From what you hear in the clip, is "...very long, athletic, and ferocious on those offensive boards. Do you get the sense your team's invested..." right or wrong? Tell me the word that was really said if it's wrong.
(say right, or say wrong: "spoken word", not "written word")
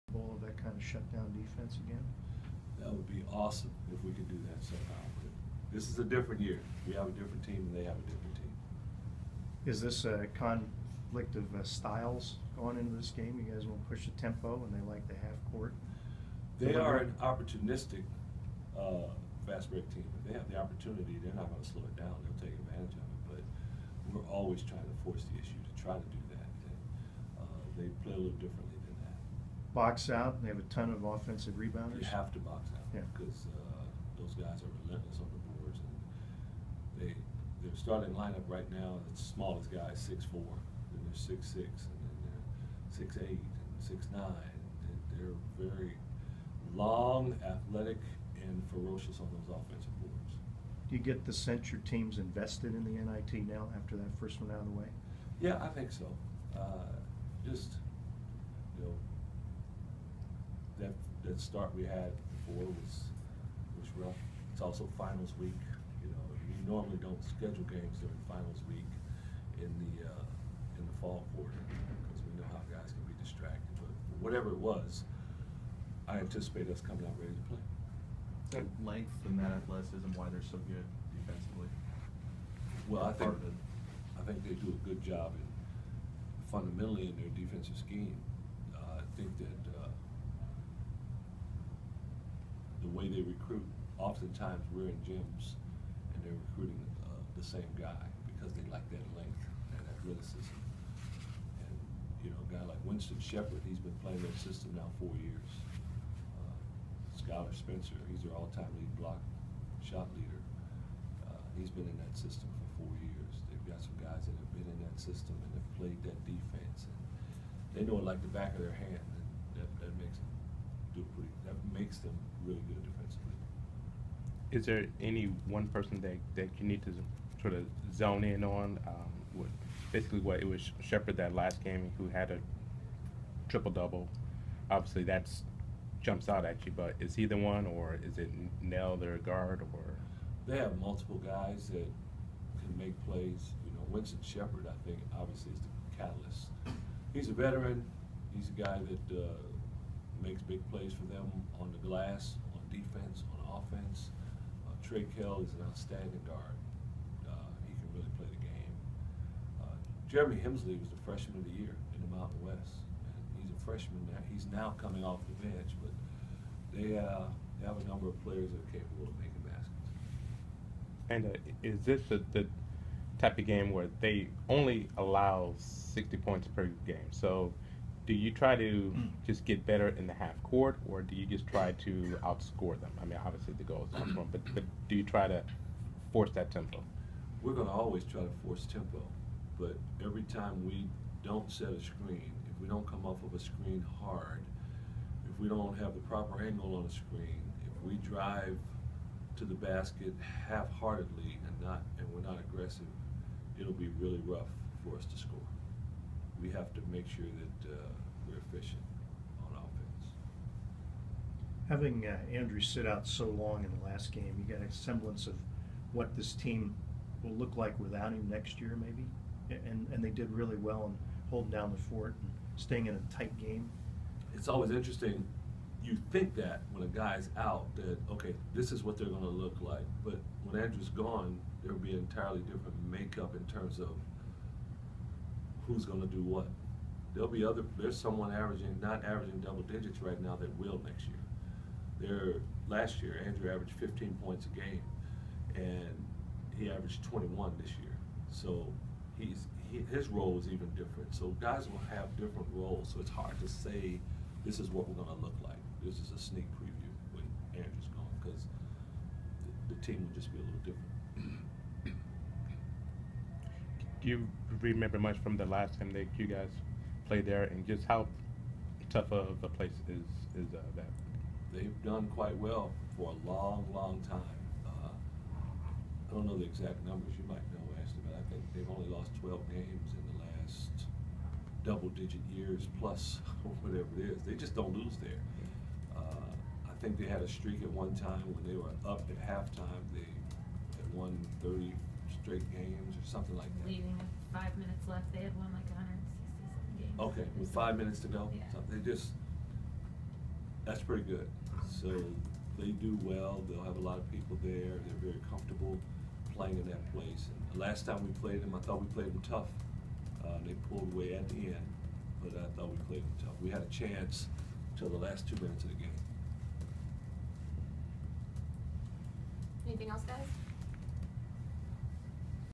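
right.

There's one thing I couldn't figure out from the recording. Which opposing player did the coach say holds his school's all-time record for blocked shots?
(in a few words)
Skylar Spencer.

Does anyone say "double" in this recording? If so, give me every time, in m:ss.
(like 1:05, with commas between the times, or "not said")
2:13, 3:59, 4:41.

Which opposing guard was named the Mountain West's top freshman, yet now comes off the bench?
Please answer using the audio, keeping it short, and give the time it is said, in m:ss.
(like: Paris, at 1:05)
Jeremy Hemsley, at 2:40.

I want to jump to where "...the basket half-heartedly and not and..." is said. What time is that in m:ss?
3:19.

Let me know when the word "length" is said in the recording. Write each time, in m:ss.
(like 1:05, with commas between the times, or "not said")
1:18, 1:39.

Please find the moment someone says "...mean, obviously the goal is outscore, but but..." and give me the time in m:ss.
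3:03.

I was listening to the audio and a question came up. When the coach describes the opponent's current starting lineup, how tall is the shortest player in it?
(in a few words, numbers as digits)
6'4".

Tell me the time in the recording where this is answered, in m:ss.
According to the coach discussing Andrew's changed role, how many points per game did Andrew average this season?
4:07.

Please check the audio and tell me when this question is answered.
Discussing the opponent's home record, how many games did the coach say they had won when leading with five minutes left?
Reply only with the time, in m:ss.
4:55.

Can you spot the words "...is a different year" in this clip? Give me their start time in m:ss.
0:05.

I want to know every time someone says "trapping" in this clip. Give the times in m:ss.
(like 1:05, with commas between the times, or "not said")
not said.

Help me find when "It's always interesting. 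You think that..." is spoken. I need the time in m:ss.
3:44.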